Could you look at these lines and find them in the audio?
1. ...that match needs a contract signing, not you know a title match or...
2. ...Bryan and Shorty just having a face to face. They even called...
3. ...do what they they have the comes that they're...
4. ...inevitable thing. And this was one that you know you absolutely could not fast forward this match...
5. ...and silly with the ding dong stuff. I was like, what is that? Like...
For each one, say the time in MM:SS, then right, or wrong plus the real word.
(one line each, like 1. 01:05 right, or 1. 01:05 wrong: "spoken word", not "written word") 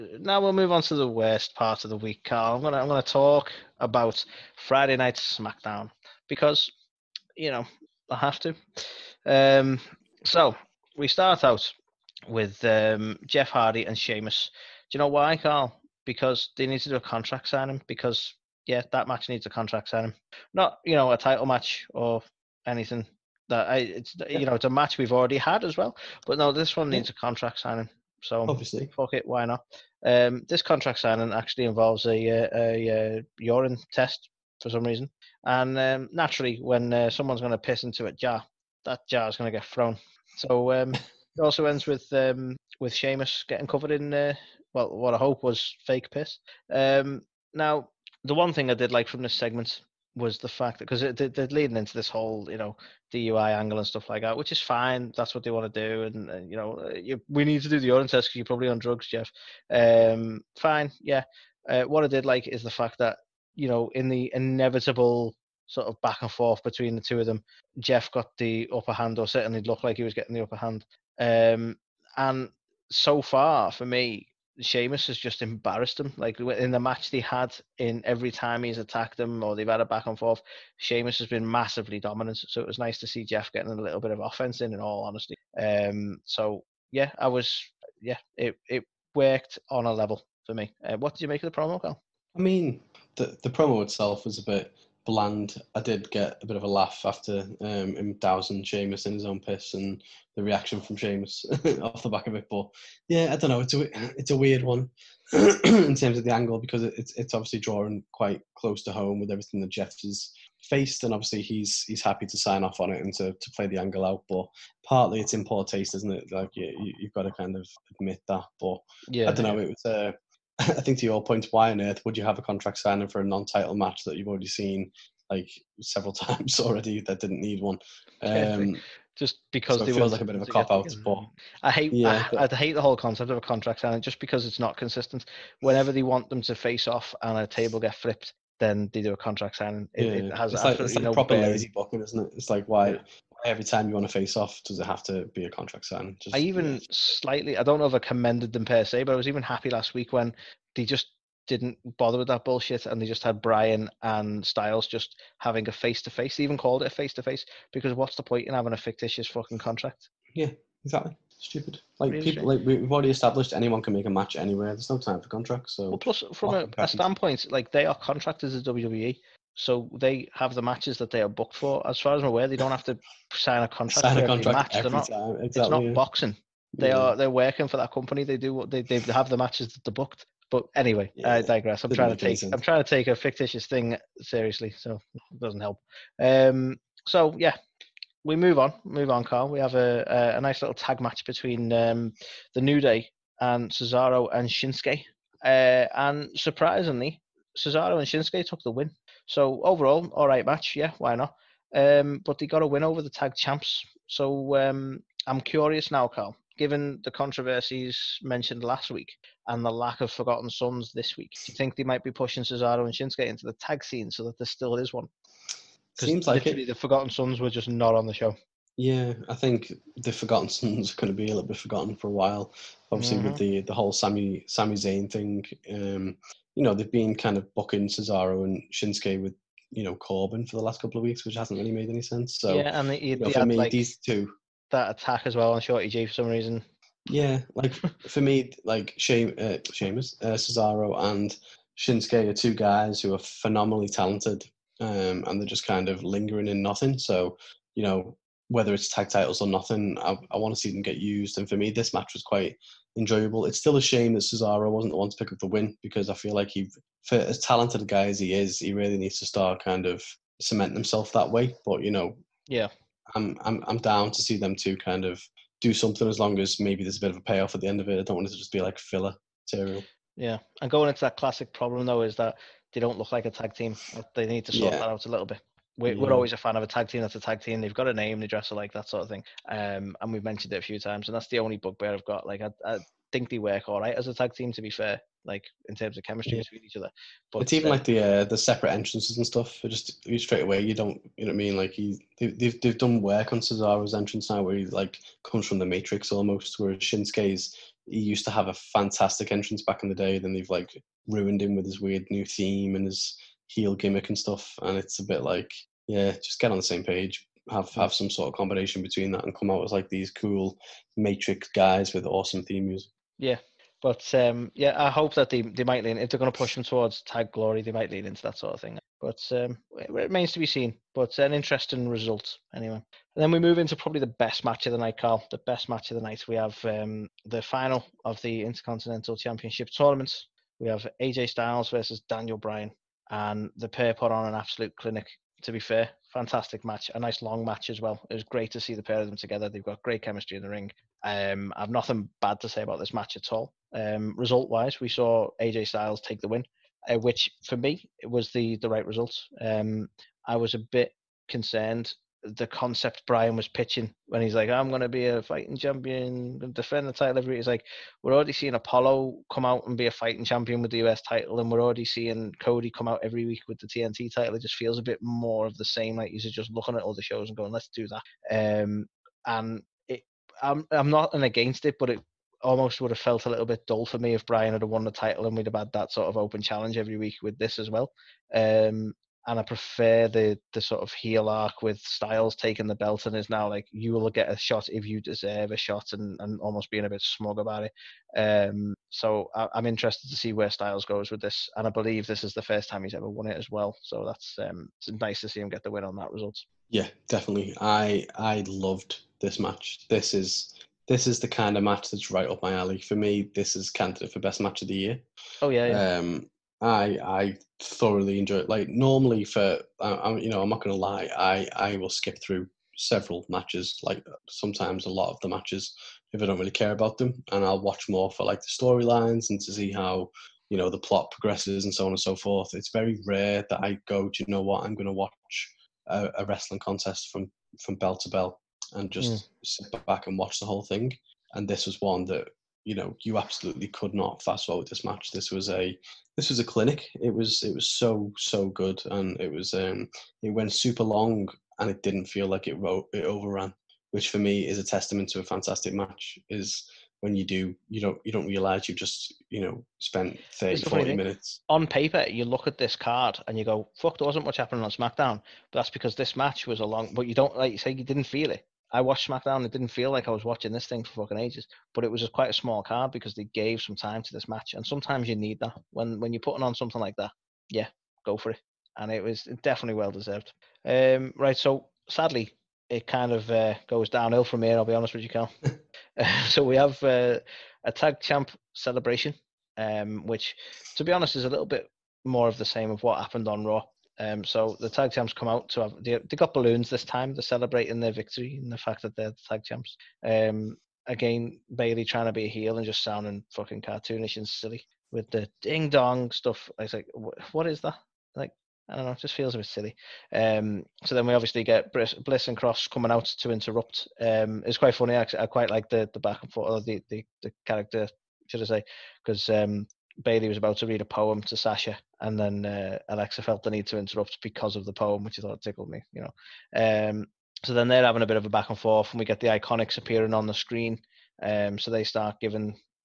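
1. 00:18 right
2. 02:33 wrong: "Styles", not "Shorty"
3. 02:58 wrong: "matches", not "comes"
4. 07:10 wrong: "whole", not "inevitable"
5. 08:14 right.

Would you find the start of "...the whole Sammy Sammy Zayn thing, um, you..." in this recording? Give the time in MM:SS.
03:43.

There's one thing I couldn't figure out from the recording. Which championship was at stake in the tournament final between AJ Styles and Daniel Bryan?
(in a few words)
Intercontinental Championship.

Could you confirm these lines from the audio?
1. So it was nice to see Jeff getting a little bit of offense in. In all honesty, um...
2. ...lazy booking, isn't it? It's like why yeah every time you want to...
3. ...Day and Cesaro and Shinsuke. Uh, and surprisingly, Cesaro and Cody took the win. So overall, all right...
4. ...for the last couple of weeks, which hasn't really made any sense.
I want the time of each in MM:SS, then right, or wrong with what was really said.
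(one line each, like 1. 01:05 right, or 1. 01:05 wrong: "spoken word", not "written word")
1. 01:22 right
2. 02:21 right
3. 03:12 wrong: "Shinsuke", not "Cody"
4. 03:50 right.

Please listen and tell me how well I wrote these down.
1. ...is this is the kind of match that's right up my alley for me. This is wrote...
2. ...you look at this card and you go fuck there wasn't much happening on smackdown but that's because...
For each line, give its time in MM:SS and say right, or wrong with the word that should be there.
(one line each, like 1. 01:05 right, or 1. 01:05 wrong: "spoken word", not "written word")
1. 06:40 wrong: "candidate", not "wrote"
2. 07:32 right.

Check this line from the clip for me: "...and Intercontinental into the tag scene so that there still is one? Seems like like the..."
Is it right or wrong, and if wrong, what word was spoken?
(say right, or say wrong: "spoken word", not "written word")
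wrong: "Shinsuke", not "Intercontinental".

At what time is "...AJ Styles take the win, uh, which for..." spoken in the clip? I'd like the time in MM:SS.
05:45.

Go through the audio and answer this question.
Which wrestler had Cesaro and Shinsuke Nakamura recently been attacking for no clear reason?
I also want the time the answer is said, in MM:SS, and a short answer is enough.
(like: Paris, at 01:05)
Shorty G, at 03:55.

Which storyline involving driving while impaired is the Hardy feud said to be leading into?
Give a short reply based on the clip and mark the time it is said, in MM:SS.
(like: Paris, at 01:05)
DUI angle, at 00:53.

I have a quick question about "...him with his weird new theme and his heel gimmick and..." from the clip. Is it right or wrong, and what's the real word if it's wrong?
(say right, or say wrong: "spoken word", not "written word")
right.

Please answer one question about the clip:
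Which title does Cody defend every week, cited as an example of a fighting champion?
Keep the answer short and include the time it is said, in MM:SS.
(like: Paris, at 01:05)
TNT title, at 06:03.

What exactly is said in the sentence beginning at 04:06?
So you know, whether it's tag titles or nothing, I, I want to see them get used.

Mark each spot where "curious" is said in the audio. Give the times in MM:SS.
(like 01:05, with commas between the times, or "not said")
03:25.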